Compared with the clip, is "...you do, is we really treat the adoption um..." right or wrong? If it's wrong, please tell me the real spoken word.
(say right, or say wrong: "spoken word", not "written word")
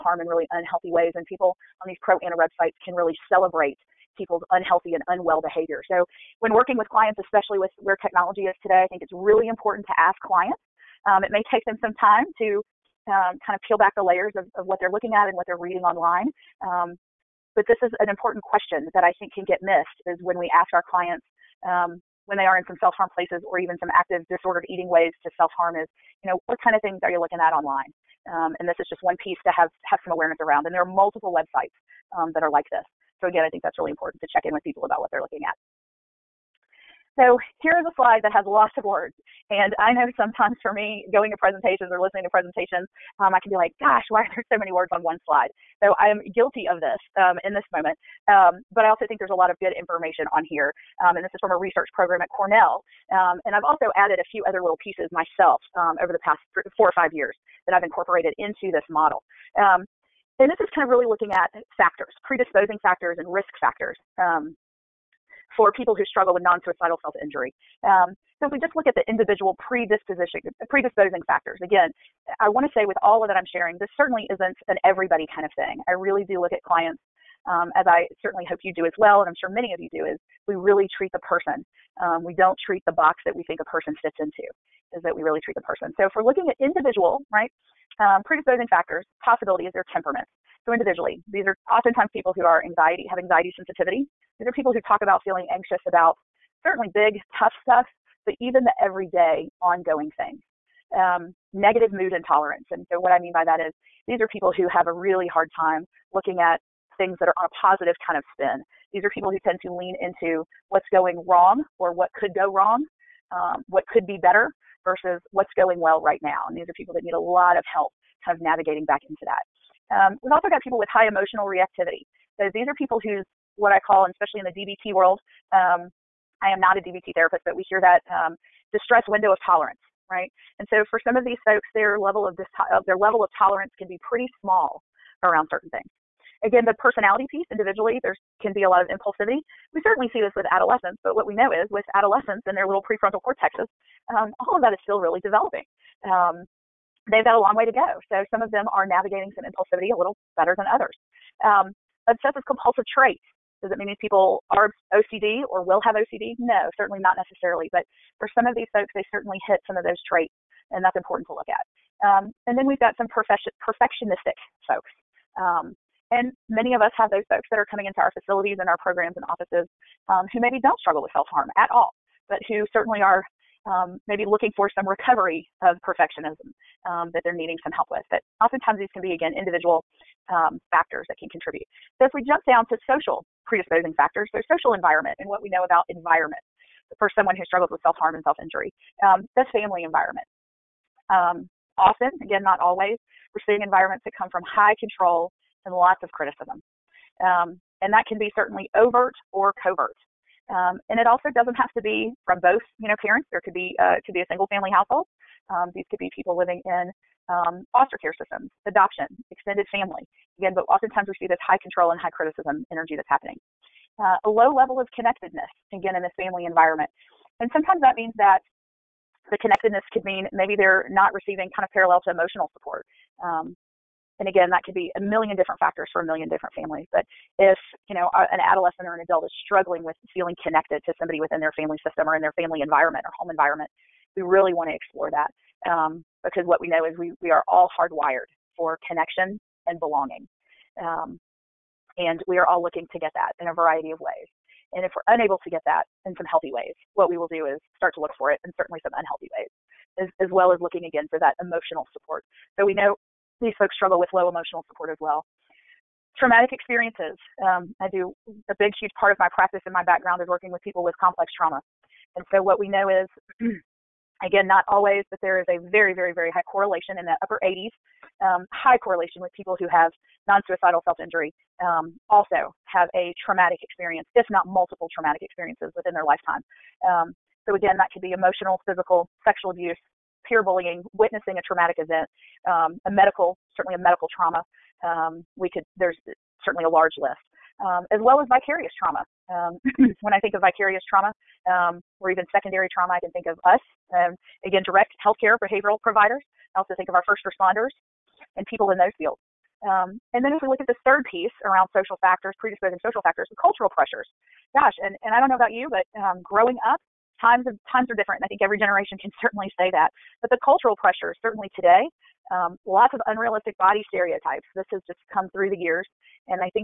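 wrong: "person", not "adoption".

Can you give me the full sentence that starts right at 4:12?
So we know these folks struggle with low emotional support as well.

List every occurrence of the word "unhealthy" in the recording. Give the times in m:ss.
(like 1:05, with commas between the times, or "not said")
0:00, 0:04, 4:08.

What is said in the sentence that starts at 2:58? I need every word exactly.
But oftentimes these can be, again, individual um, factors that can contribute.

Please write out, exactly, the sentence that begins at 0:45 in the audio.
So I am guilty of this um, in this moment.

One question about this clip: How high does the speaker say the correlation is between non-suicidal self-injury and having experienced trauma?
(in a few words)
upper 80s.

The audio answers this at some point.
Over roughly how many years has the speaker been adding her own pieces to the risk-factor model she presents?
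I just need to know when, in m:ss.
0:56.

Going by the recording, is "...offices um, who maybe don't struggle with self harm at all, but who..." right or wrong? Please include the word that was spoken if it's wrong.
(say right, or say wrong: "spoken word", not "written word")
right.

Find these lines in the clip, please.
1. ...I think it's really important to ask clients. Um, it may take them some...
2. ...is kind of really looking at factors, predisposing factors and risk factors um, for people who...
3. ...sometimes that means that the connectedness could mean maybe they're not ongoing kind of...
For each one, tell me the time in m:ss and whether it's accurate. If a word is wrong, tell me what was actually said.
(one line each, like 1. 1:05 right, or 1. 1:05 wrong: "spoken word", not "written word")
1. 0:08 right
2. 1:00 right
3. 3:37 wrong: "receiving", not "ongoing".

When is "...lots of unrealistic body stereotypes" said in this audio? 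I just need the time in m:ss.
5:12.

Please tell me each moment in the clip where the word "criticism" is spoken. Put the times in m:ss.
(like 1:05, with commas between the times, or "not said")
3:16, 3:32.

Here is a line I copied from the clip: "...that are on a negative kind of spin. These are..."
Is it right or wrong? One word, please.
wrong.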